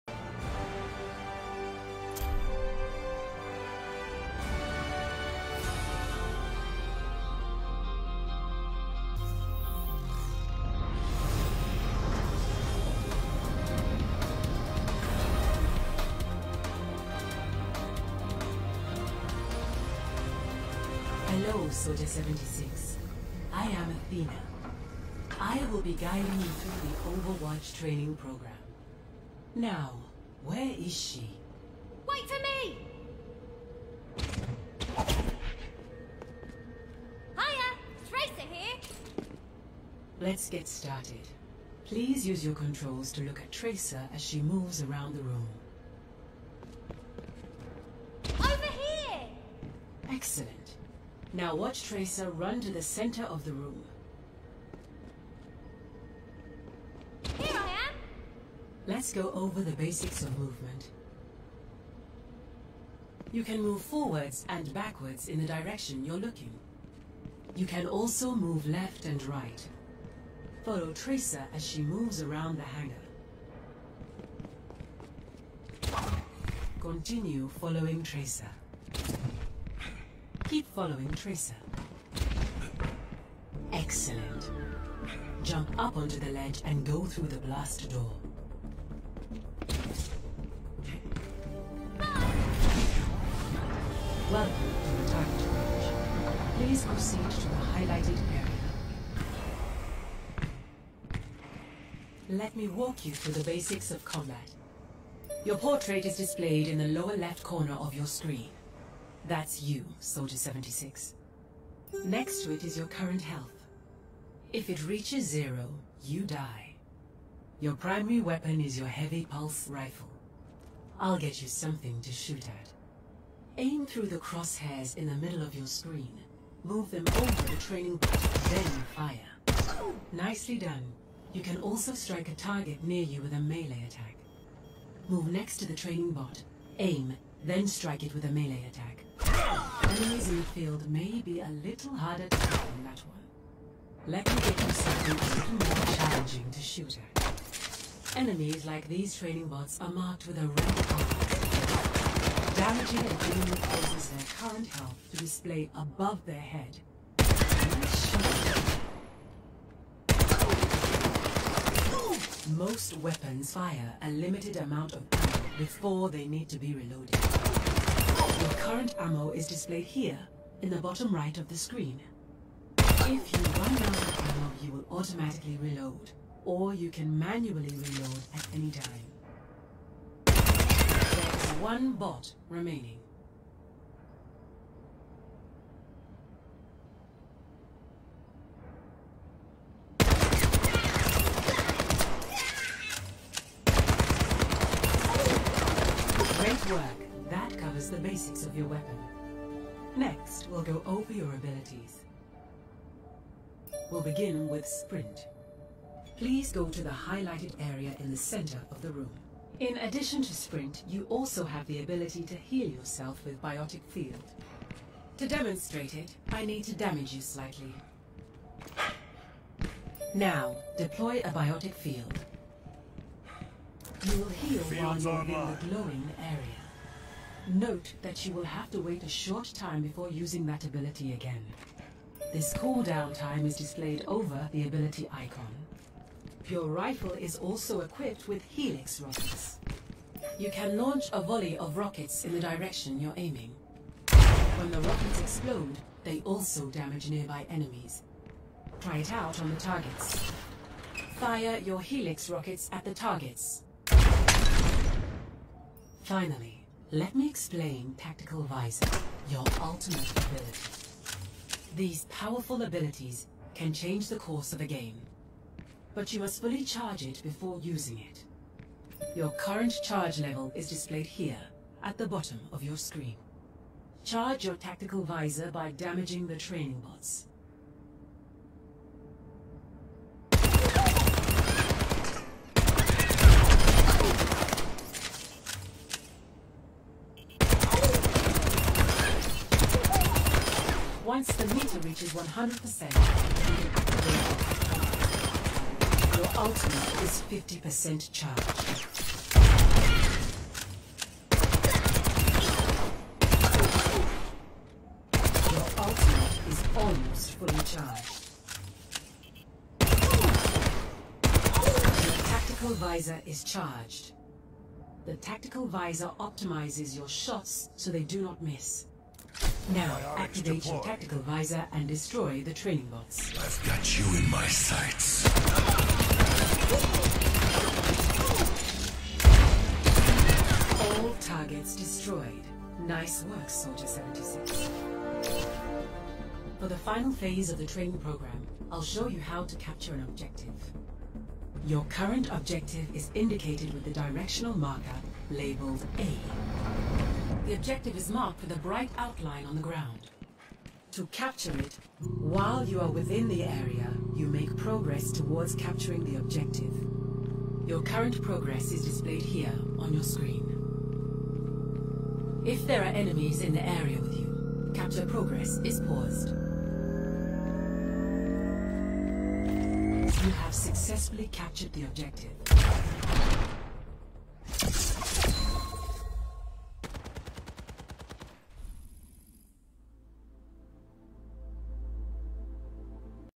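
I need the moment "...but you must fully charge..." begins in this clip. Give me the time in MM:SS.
04:25.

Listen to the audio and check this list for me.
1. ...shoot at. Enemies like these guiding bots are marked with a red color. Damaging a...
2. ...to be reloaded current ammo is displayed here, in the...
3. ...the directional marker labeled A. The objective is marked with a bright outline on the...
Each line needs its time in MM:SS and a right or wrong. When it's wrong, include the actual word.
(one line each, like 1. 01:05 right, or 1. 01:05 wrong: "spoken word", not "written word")
1. 02:26 wrong: "training", not "guiding"
2. 02:46 right
3. 05:43 right.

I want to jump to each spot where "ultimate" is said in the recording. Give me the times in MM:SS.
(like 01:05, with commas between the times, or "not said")
04:19, 04:56, 05:05.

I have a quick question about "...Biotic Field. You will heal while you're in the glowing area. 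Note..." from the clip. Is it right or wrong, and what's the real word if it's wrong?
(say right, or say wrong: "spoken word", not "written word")
right.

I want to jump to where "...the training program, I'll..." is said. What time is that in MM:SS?
05:37.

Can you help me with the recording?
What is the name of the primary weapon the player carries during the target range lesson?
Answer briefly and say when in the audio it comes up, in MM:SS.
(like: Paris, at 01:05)
Heavy pulse rifle, at 01:58.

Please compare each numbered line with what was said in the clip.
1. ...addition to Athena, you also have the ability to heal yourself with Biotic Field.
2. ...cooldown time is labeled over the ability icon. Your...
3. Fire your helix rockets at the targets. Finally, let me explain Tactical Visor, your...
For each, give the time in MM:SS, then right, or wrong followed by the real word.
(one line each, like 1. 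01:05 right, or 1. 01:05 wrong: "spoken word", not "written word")
1. 03:29 wrong: "Sprint", not "Athena"
2. 03:52 wrong: "displayed", not "labeled"
3. 04:11 right.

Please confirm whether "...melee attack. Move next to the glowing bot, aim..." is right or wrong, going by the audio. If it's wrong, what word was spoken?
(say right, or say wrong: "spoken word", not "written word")
wrong: "training", not "glowing".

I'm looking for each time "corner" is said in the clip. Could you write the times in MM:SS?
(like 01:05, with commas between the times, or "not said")
01:47.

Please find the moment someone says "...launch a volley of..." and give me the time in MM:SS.
04:00.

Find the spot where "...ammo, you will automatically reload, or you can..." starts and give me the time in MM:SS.
02:54.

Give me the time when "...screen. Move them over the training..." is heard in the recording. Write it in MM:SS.
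02:05.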